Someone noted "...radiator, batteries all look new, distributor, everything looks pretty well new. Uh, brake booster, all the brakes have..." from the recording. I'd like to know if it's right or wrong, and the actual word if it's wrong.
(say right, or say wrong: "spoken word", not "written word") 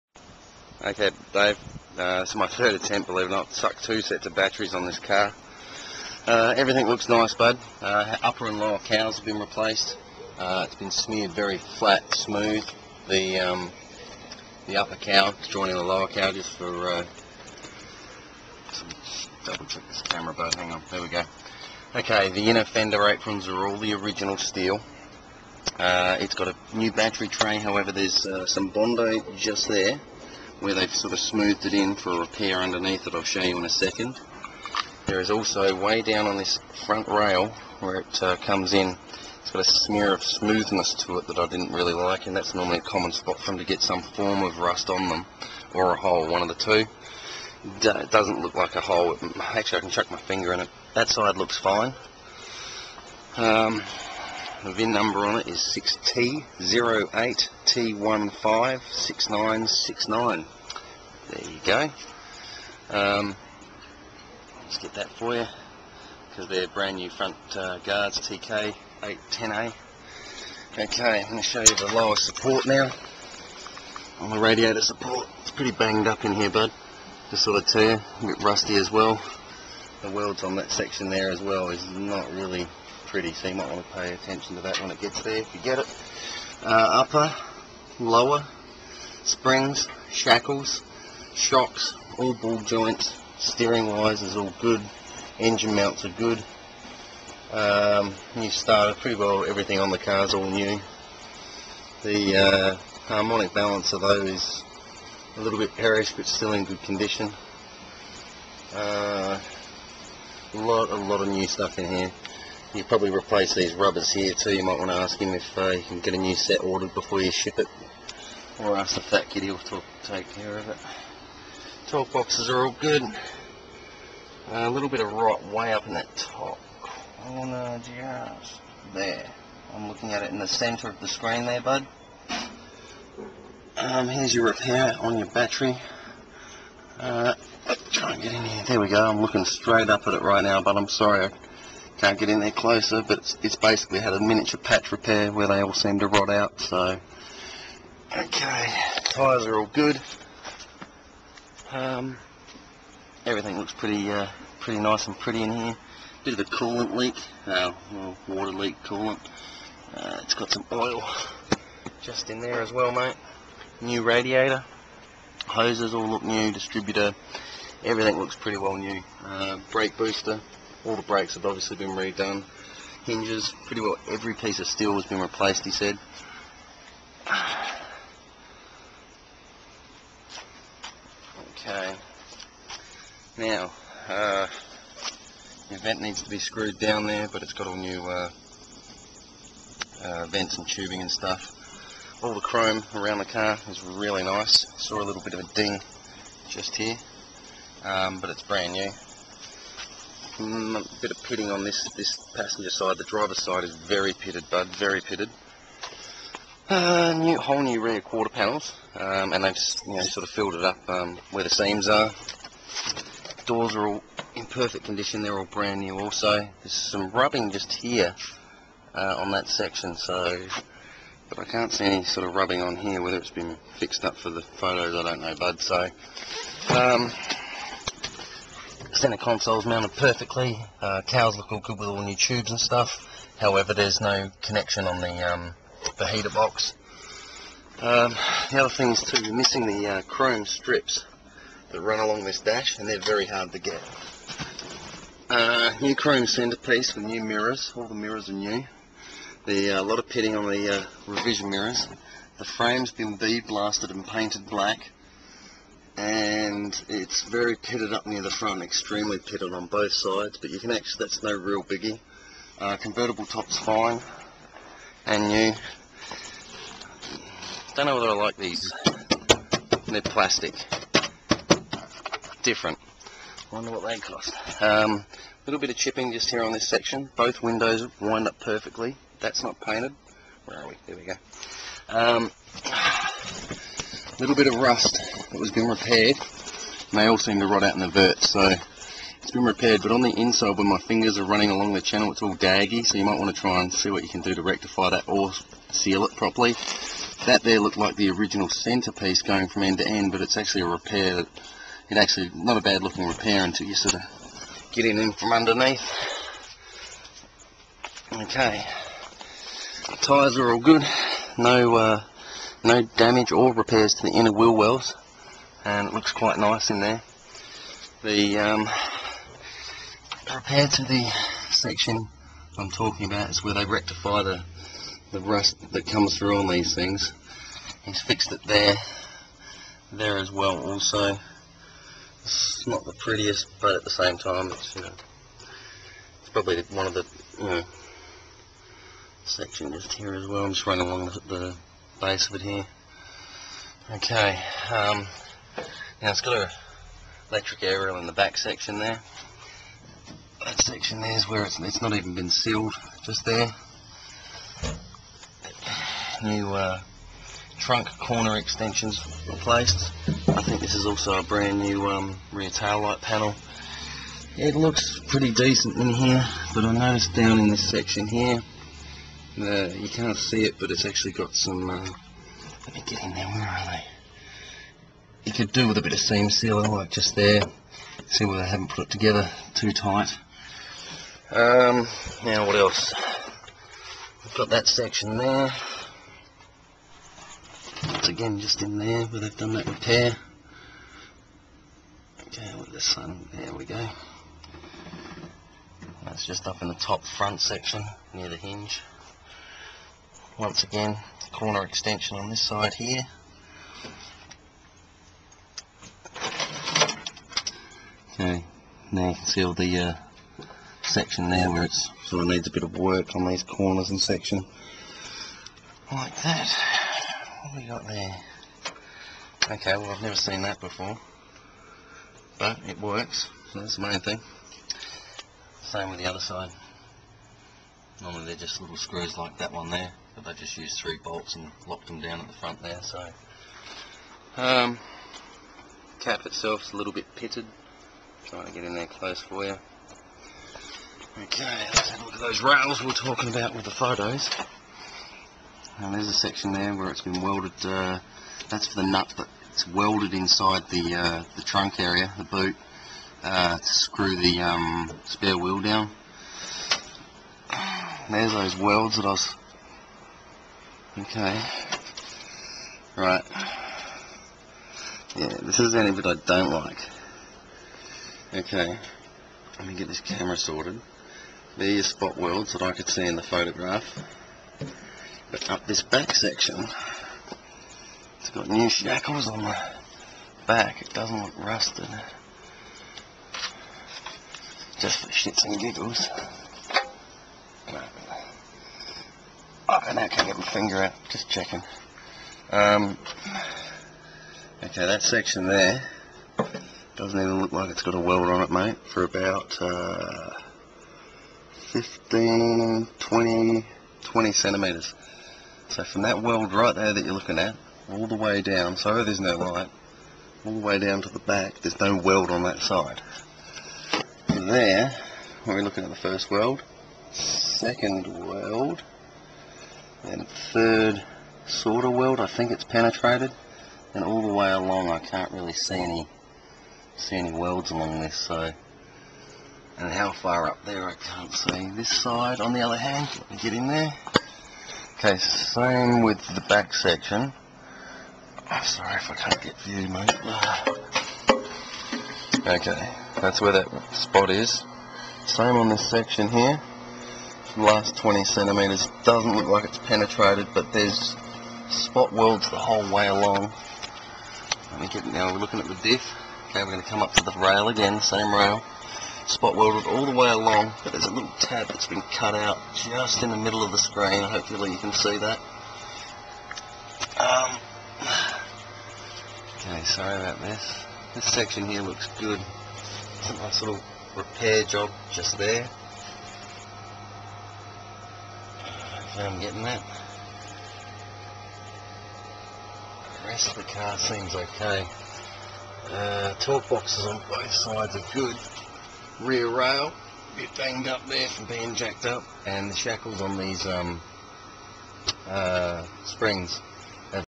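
wrong: "hoses", not "batteries".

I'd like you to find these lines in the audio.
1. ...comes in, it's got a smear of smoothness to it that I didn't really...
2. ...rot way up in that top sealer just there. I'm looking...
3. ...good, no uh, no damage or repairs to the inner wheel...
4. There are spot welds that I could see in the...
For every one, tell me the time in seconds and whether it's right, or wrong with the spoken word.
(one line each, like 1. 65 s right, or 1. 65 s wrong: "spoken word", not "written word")
1. 38 s right
2. 125 s wrong: "corner", not "sealer"
3. 310 s right
4. 471 s right.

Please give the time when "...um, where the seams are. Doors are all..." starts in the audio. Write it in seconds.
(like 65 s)
210 s.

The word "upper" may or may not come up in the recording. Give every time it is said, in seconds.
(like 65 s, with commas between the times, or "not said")
8 s, 14 s, 87 s.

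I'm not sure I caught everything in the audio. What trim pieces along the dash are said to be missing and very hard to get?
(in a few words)
chrome strips.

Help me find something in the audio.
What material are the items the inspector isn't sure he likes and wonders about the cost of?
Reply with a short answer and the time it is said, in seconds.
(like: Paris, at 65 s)
plastic, at 270 s.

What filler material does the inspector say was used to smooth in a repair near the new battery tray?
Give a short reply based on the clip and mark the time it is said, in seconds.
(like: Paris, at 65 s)
Bondo, at 28 s.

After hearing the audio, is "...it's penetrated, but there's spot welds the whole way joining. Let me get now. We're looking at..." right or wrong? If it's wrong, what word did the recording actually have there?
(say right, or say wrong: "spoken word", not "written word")
wrong: "along", not "joining".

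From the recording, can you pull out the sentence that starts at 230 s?
Uh, cows look all good with all new tubes and stuff.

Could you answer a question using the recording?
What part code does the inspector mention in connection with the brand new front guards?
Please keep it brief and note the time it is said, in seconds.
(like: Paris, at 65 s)
TK810A, at 68 s.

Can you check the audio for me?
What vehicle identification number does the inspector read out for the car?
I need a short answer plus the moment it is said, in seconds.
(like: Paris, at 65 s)
6T08T156969, at 55 s.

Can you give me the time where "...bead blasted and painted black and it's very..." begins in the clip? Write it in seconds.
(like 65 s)
253 s.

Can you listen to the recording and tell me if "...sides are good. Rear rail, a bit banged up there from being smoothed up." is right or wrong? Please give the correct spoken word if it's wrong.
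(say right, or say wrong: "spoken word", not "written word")
wrong: "jacked", not "smoothed".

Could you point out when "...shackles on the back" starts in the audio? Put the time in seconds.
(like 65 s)
478 s.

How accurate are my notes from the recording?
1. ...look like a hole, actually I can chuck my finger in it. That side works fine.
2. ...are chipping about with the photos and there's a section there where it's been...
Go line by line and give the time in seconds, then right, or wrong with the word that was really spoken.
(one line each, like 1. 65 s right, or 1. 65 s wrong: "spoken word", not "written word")
1. 48 s wrong: "looks", not "works"
2. 442 s wrong: "talking", not "chipping".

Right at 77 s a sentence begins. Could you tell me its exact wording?
Just sort of tear, a bit rusty as well.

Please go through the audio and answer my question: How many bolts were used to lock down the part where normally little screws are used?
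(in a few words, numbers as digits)
3.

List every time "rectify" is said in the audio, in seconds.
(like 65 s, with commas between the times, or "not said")
294 s, 323 s.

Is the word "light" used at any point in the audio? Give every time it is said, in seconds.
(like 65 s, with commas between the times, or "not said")
362 s, 509 s.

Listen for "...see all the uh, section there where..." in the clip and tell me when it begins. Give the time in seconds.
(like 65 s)
409 s.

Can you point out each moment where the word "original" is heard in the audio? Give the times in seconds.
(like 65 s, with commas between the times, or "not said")
23 s, 298 s.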